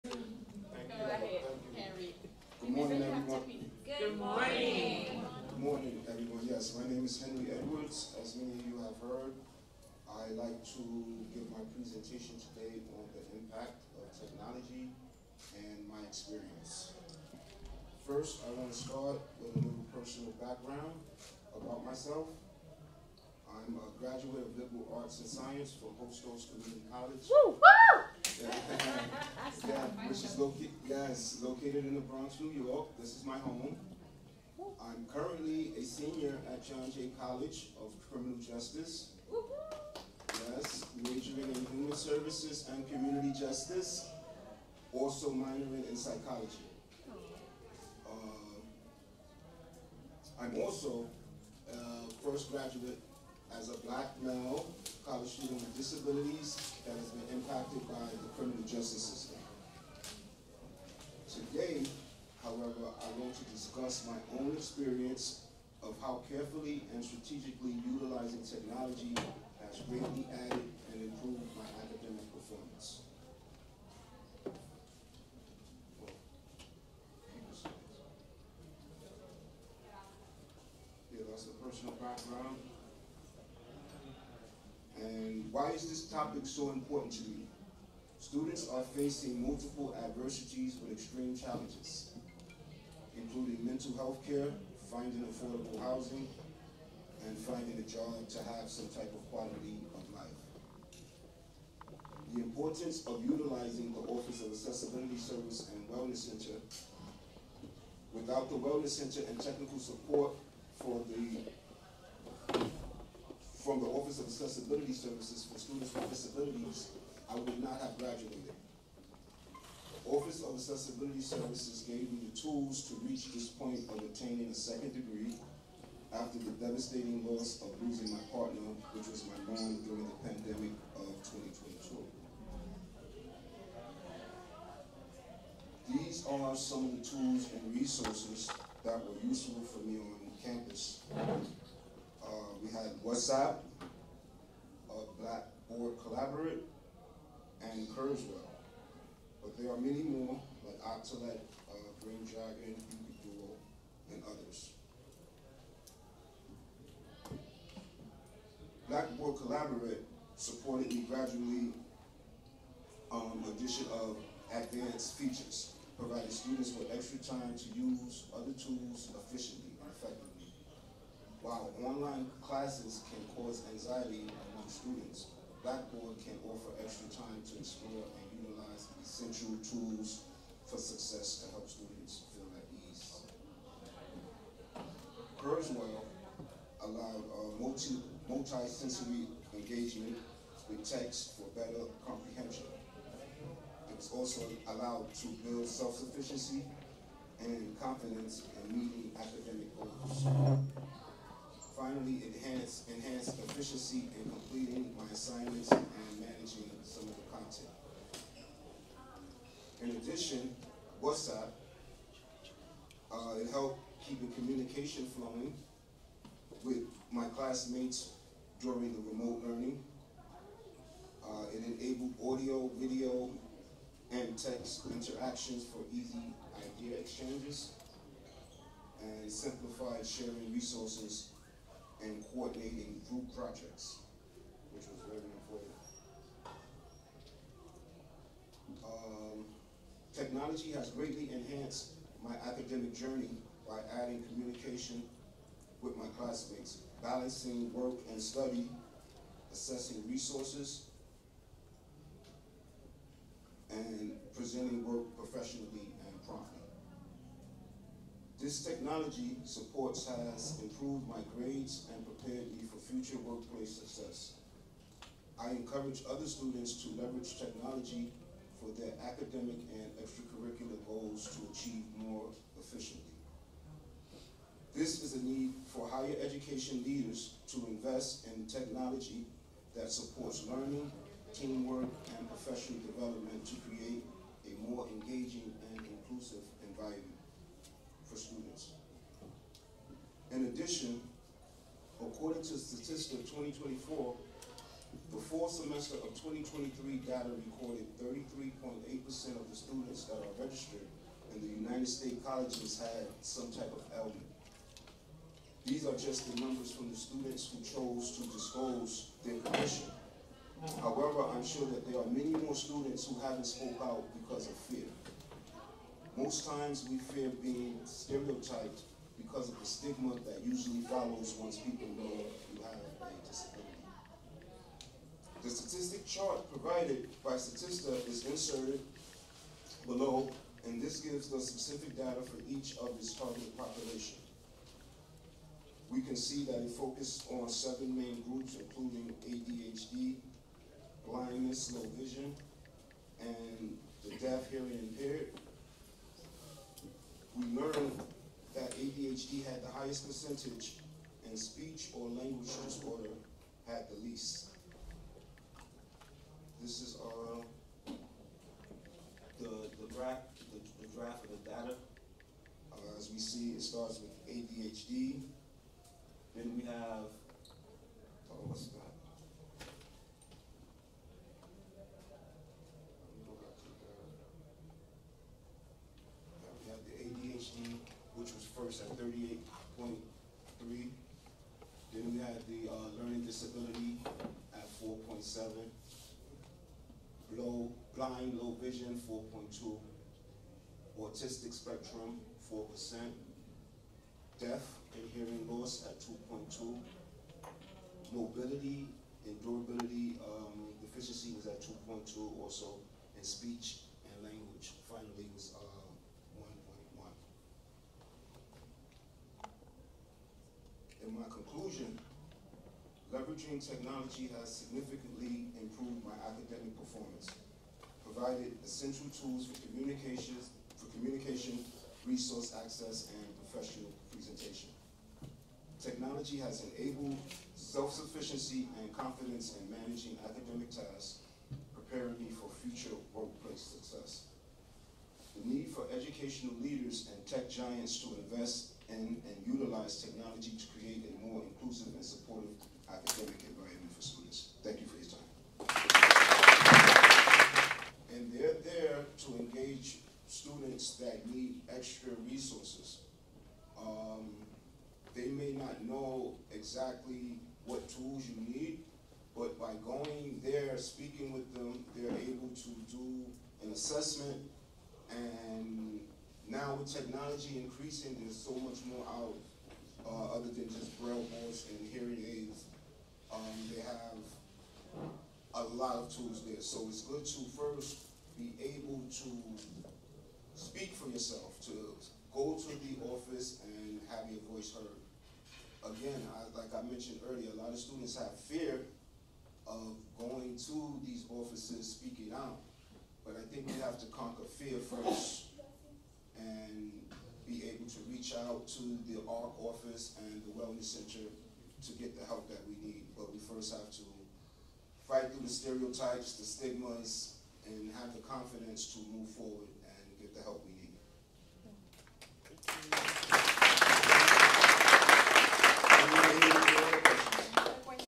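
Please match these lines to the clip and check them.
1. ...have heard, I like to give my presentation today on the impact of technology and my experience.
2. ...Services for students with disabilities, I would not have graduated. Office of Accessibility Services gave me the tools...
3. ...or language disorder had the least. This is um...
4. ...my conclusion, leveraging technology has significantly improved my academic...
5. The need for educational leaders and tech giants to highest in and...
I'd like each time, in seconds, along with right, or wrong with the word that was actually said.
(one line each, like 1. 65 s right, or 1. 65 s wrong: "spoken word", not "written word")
1. 8 s right
2. 114 s right
3. 351 s right
4. 411 s right
5. 435 s wrong: "invest", not "highest".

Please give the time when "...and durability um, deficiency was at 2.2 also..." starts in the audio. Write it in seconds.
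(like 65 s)
399 s.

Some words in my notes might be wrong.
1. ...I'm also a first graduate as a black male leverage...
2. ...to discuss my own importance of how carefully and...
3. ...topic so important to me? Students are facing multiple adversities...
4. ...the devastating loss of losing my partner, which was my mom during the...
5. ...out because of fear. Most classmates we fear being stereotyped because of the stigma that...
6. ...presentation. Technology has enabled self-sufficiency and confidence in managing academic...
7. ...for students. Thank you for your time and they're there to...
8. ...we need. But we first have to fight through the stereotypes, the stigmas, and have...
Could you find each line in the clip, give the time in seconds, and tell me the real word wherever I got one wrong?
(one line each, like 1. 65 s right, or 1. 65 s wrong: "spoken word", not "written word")
1. 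50 s wrong: "college", not "leverage"
2. 63 s wrong: "experience", not "importance"
3. 86 s right
4. 126 s right
5. 313 s wrong: "times", not "classmates"
6. 424 s right
7. 443 s right
8. 502 s right.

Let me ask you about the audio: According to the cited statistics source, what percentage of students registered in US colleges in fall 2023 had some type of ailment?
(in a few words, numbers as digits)
33.8%.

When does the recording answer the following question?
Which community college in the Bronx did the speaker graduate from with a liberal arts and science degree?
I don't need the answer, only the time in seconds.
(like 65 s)
25 s.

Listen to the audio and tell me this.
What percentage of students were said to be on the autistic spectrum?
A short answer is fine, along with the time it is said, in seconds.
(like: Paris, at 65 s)
4%, at 392 s.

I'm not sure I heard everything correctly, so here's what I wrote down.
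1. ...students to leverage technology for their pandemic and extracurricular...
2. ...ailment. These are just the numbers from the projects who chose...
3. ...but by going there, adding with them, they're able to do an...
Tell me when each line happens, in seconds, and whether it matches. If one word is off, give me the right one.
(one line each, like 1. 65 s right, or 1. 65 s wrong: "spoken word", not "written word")
1. 266 s wrong: "academic", not "pandemic"
2. 303 s wrong: "students", not "projects"
3. 459 s wrong: "speaking", not "adding".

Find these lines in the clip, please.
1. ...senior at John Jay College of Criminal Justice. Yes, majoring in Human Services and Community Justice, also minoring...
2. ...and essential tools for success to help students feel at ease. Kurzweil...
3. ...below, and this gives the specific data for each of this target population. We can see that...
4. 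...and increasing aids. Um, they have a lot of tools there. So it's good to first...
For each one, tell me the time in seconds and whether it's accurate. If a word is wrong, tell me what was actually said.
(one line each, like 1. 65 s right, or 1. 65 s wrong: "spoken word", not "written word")
1. 35 s right
2. 178 s right
3. 329 s right
4. 471 s wrong: "hearing", not "increasing".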